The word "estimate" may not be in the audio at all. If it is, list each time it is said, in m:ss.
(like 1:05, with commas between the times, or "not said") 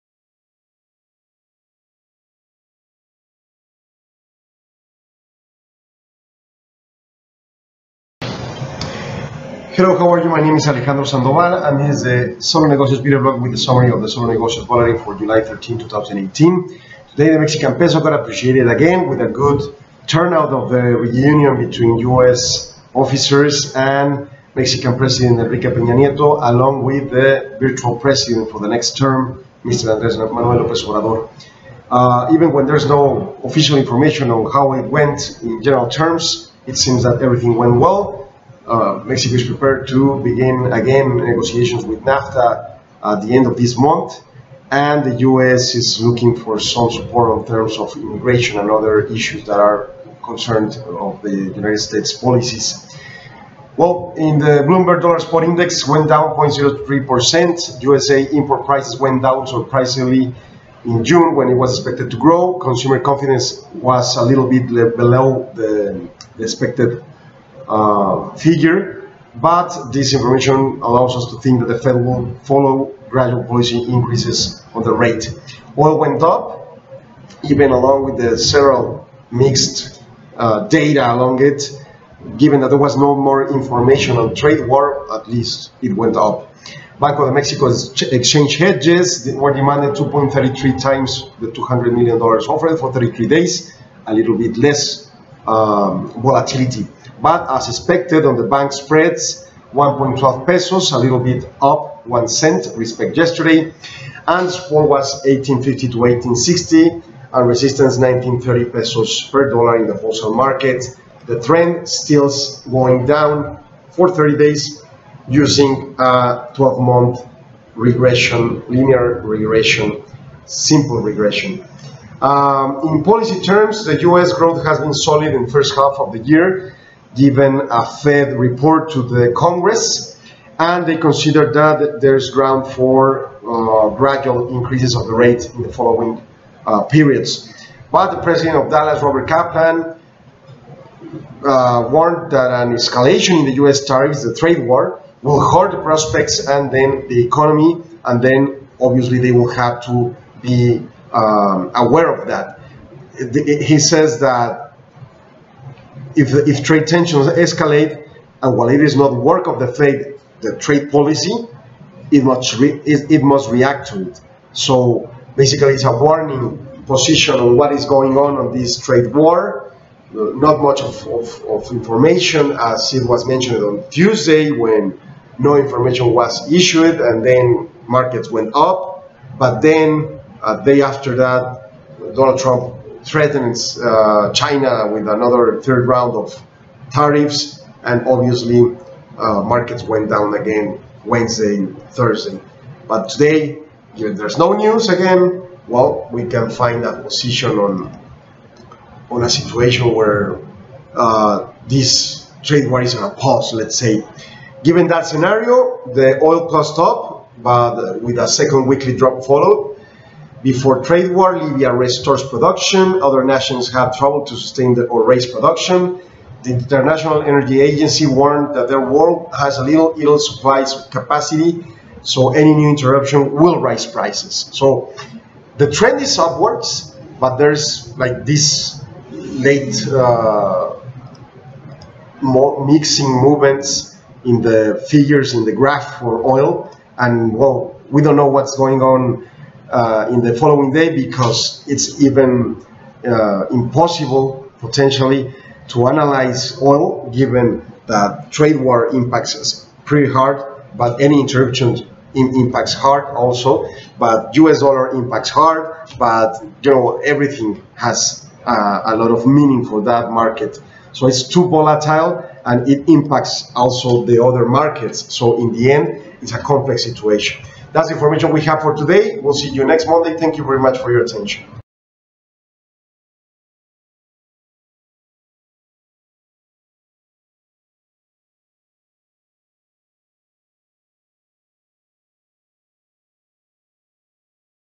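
not said.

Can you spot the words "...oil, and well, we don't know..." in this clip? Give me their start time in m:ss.
3:56.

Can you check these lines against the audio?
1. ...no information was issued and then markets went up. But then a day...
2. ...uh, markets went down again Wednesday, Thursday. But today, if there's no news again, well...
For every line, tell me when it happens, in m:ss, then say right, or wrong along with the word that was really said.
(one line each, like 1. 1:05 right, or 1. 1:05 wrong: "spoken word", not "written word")
1. 2:55 right
2. 3:09 right.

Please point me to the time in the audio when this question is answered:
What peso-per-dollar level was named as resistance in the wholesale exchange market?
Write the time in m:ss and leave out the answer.
1:47.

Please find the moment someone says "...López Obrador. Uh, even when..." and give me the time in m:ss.
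0:30.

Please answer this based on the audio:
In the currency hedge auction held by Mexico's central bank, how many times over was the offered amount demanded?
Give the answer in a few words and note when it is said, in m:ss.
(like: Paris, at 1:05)
2.33 times, at 1:29.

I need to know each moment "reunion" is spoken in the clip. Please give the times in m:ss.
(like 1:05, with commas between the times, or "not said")
0:20.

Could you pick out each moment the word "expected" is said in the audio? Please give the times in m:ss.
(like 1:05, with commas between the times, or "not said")
1:01, 1:06, 1:37.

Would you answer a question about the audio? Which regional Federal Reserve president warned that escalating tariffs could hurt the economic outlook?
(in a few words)
Robert Kaplan.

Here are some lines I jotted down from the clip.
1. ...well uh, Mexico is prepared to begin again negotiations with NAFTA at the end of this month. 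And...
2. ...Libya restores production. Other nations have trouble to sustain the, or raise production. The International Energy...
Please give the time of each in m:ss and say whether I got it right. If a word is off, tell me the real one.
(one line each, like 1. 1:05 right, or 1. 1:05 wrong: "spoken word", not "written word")
1. 0:37 right
2. 3:31 right.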